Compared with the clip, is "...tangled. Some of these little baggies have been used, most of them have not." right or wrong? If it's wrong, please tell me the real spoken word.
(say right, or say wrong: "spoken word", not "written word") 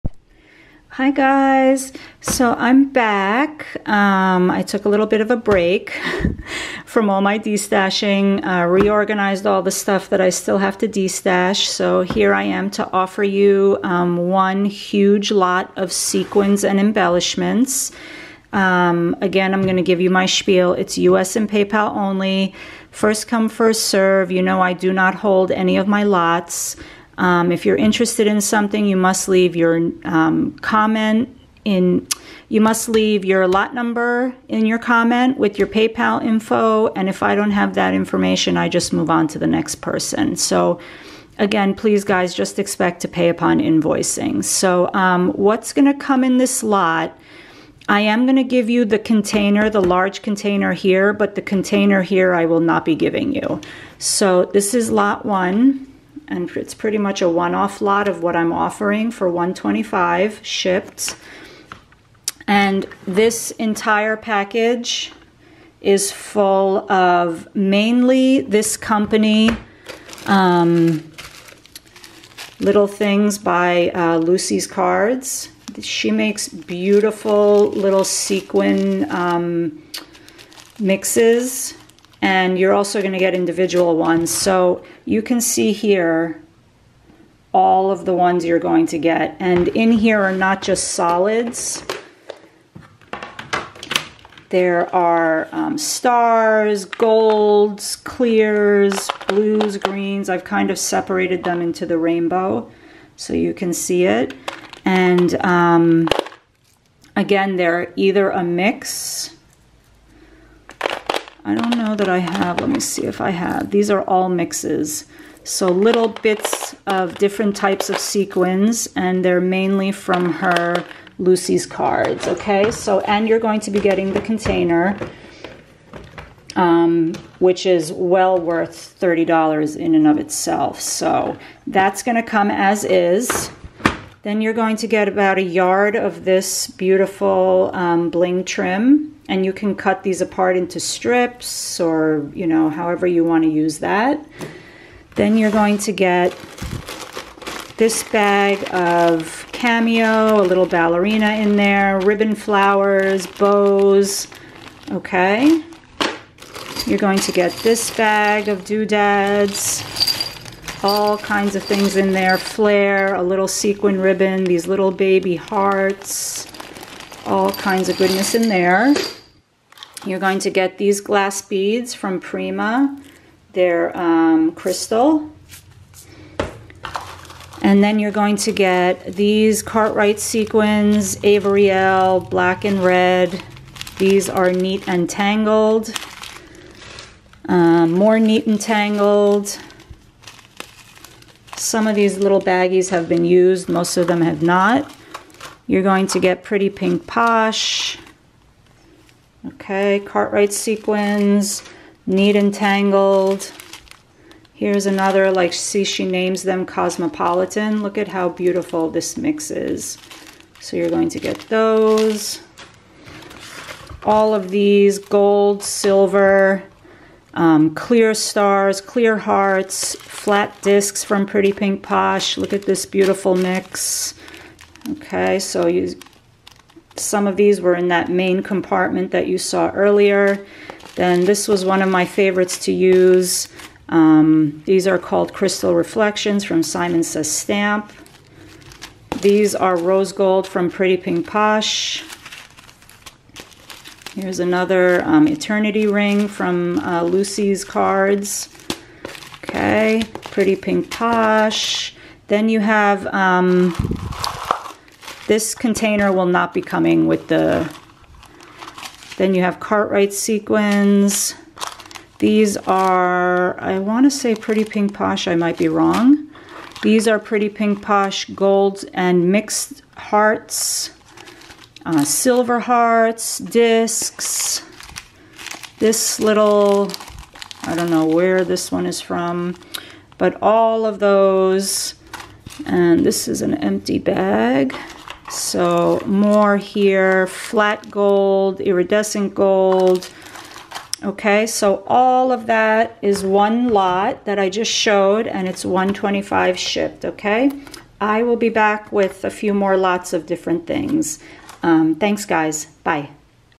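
right.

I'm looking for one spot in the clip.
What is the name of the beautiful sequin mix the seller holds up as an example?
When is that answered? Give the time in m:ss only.
3:26.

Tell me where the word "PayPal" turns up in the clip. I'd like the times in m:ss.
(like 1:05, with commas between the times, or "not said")
0:21, 0:35.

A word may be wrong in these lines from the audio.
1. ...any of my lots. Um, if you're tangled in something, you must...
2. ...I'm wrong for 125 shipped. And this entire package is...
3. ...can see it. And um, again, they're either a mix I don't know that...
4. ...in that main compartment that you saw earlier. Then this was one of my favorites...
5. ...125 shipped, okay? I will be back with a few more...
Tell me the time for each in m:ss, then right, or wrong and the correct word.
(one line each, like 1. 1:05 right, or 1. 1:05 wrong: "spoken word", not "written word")
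1. 0:25 wrong: "interested", not "tangled"
2. 0:58 wrong: "offering", not "wrong"
3. 1:43 right
4. 3:47 right
5. 4:55 right.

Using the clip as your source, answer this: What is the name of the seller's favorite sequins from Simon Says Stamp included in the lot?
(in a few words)
Crystal Reflections.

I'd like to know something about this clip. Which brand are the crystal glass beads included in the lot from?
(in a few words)
Prima.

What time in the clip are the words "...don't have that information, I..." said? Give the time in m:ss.
0:37.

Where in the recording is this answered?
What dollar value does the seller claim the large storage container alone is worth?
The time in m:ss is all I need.
2:08.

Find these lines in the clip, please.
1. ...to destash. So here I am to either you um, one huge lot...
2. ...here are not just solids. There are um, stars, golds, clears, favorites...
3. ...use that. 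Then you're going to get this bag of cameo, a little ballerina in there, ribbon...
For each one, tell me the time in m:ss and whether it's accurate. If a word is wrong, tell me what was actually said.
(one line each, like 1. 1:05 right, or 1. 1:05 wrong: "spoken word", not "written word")
1. 0:10 wrong: "offer", not "either"
2. 1:29 wrong: "blues", not "favorites"
3. 2:23 right.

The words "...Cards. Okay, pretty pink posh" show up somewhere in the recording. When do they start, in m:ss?
4:07.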